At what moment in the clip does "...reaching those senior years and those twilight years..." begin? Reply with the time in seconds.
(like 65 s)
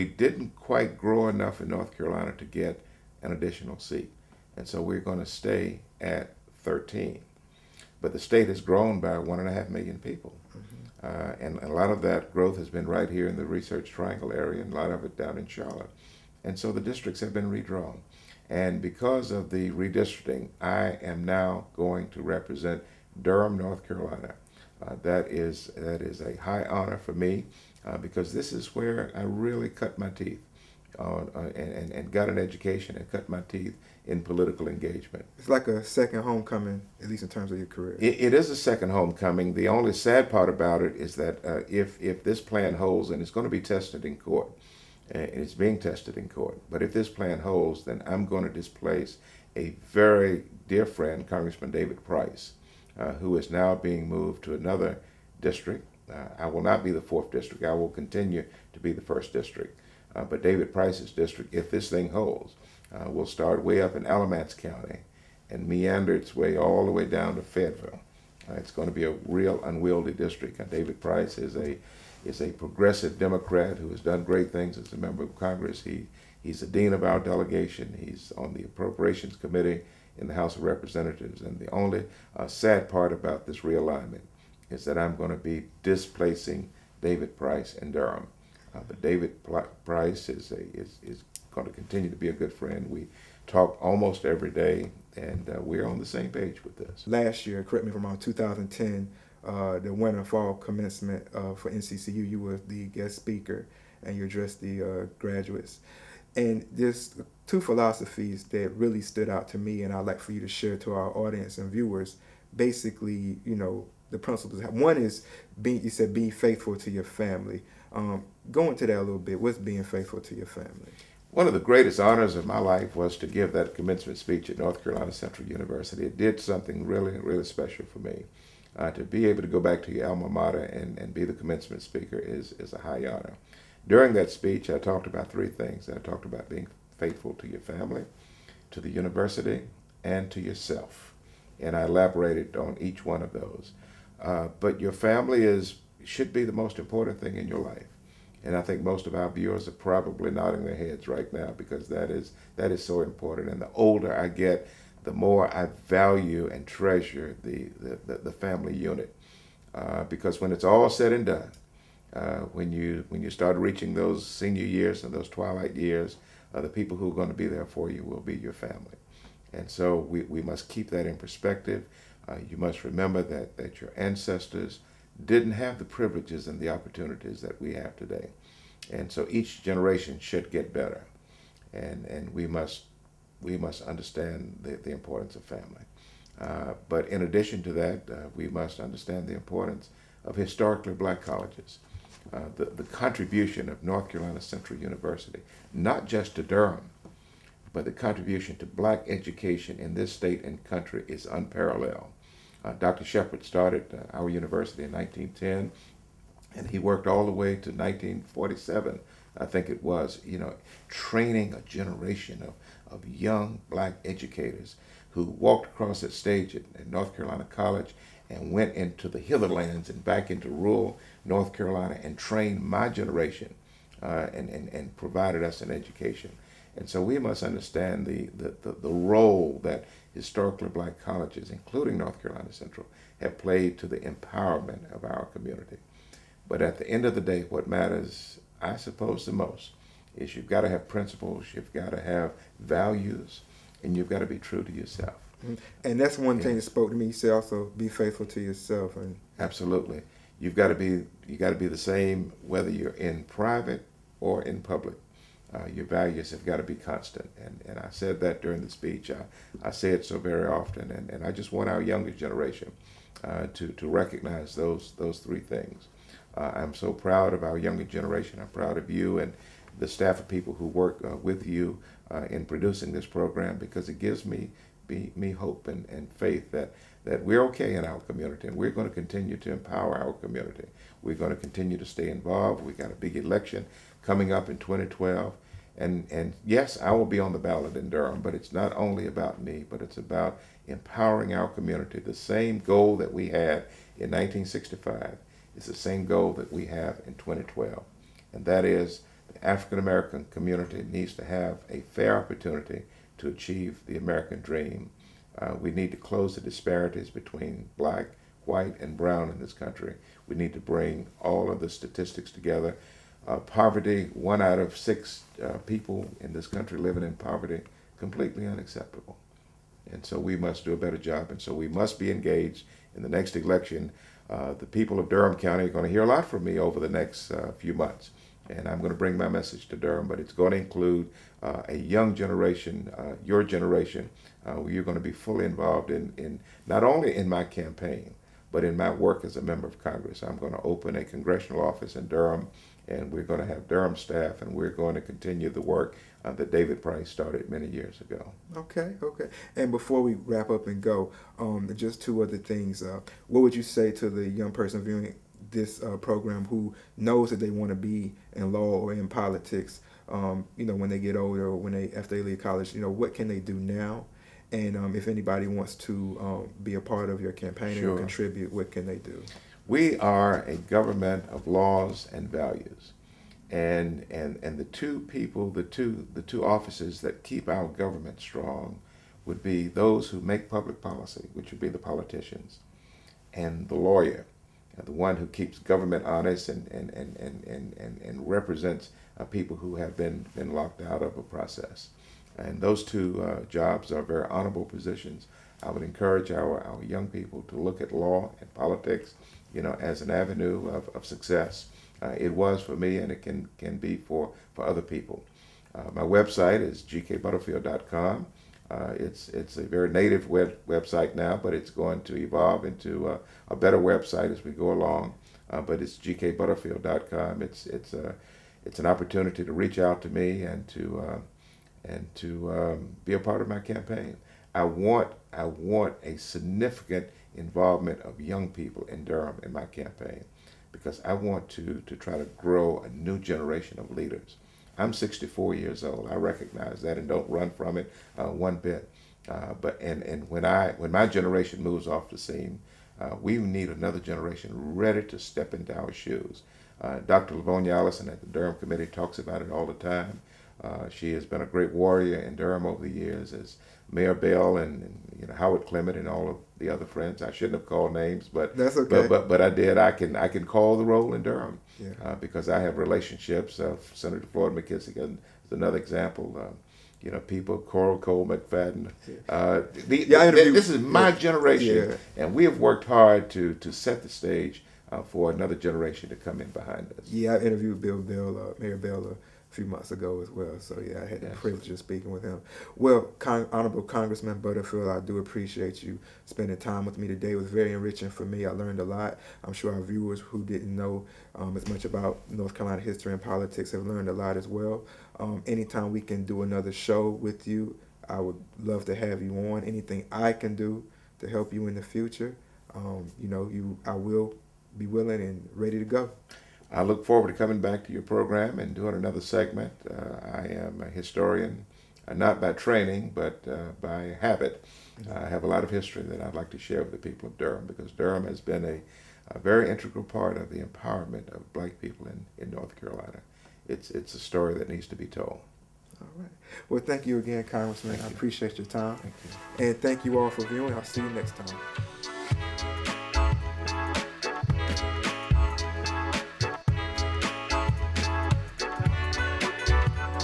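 163 s.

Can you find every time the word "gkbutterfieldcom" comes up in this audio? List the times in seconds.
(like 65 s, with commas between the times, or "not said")
406 s, 415 s.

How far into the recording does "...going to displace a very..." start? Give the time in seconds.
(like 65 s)
48 s.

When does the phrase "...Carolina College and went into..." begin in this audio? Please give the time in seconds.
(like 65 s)
217 s.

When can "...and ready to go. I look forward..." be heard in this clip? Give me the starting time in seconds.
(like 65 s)
505 s.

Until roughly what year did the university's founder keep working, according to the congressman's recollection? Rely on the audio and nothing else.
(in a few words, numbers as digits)
1947.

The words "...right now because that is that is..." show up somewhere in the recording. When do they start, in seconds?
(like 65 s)
151 s.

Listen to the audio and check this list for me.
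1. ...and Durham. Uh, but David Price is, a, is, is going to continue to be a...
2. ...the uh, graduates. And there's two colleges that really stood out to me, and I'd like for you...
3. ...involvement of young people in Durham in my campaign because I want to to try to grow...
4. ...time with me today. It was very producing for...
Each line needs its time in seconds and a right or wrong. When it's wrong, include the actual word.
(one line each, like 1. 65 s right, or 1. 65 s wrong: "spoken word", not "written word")
1. 87 s right
2. 104 s wrong: "philosophies", not "colleges"
3. 427 s right
4. 486 s wrong: "enriching", not "producing".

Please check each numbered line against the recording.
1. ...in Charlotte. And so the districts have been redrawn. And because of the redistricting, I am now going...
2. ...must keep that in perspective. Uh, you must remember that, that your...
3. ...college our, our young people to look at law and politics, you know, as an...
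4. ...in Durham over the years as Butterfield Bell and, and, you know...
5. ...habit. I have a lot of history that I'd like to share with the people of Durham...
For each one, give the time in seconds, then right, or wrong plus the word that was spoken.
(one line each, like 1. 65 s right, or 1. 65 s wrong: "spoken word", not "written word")
1. 15 s right
2. 170 s right
3. 395 s wrong: "encourage", not "college"
4. 452 s wrong: "Mayor", not "Butterfield"
5. 514 s right.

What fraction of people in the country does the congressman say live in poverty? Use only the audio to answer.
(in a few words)
one out of six.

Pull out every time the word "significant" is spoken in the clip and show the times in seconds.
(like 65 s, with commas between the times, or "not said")
426 s.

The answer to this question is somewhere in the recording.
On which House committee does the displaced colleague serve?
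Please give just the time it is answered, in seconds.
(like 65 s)
78 s.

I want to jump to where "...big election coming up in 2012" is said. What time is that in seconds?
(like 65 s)
282 s.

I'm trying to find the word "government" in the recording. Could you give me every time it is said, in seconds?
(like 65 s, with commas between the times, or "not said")
370 s, 377 s, 385 s.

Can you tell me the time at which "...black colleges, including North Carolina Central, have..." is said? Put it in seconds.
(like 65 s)
230 s.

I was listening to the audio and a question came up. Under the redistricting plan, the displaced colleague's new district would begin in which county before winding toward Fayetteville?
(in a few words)
Alamance County.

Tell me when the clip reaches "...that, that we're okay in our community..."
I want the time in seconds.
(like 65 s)
276 s.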